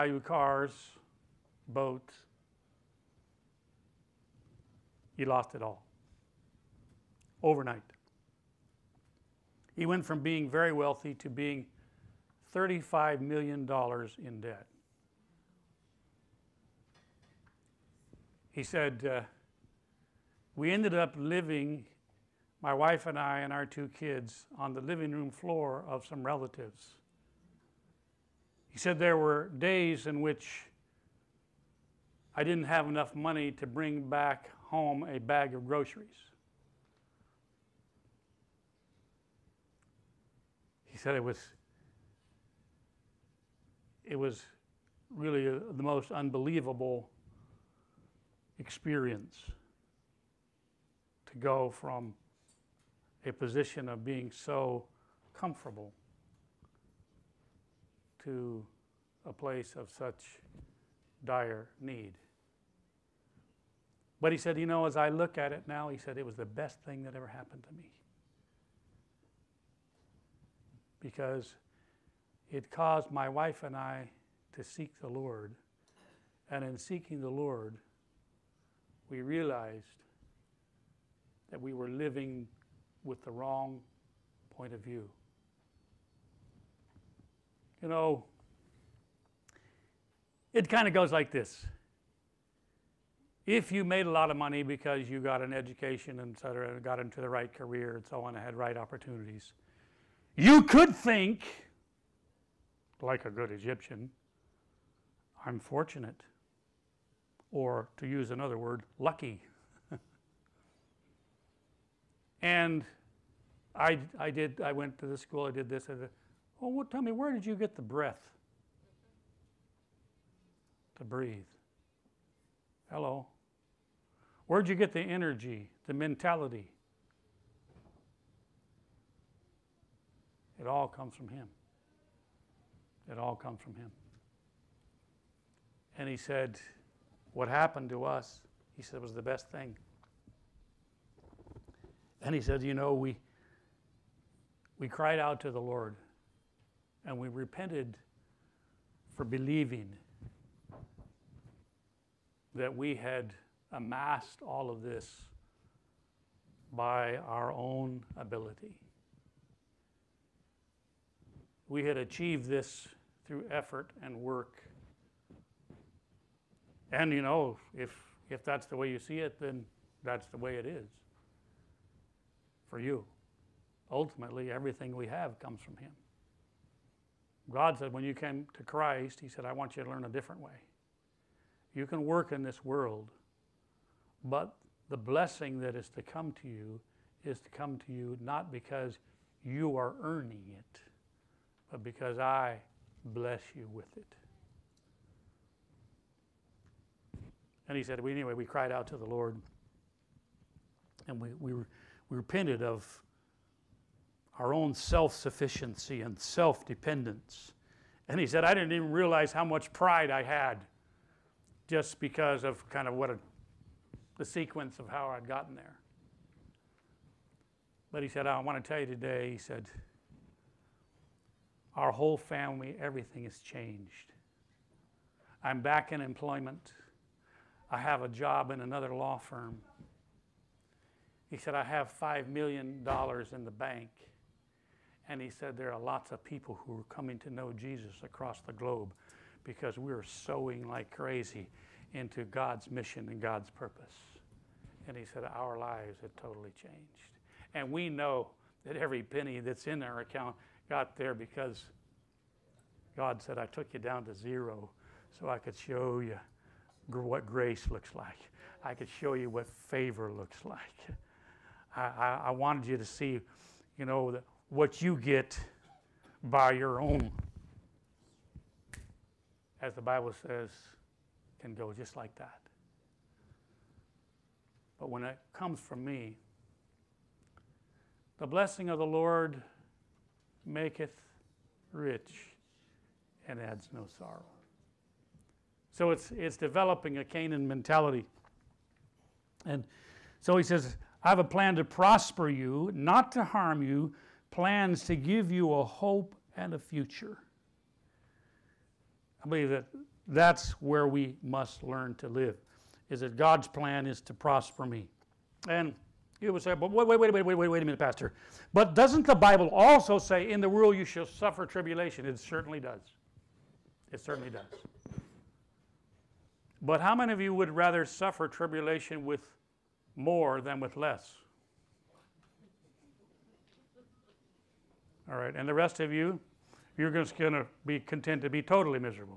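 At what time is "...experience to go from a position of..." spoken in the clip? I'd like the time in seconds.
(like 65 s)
48 s.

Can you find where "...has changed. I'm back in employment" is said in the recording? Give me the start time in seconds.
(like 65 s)
223 s.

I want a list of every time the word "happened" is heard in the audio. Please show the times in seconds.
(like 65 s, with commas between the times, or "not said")
67 s, 137 s.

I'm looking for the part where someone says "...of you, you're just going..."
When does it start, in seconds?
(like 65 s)
325 s.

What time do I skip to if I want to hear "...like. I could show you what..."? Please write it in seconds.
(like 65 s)
257 s.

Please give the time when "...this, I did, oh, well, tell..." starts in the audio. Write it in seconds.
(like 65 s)
115 s.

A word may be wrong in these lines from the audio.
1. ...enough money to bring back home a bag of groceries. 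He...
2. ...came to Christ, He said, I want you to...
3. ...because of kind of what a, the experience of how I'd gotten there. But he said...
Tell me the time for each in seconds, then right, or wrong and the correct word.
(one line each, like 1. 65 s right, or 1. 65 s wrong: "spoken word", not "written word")
1. 32 s right
2. 178 s right
3. 211 s wrong: "sequence", not "experience".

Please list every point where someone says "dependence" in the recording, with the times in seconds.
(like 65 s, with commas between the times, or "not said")
206 s.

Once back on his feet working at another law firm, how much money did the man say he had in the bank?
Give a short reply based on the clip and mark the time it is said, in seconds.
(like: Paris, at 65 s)
$5 million, at 232 s.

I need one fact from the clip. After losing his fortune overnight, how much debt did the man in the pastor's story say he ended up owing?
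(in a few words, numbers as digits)
$35 million.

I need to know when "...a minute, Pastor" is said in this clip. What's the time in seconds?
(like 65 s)
307 s.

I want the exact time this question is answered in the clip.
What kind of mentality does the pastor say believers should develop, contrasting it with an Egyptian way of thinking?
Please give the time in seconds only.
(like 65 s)
287 s.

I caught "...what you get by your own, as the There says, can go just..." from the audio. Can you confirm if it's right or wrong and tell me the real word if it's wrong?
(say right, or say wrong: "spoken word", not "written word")
wrong: "Bible", not "There".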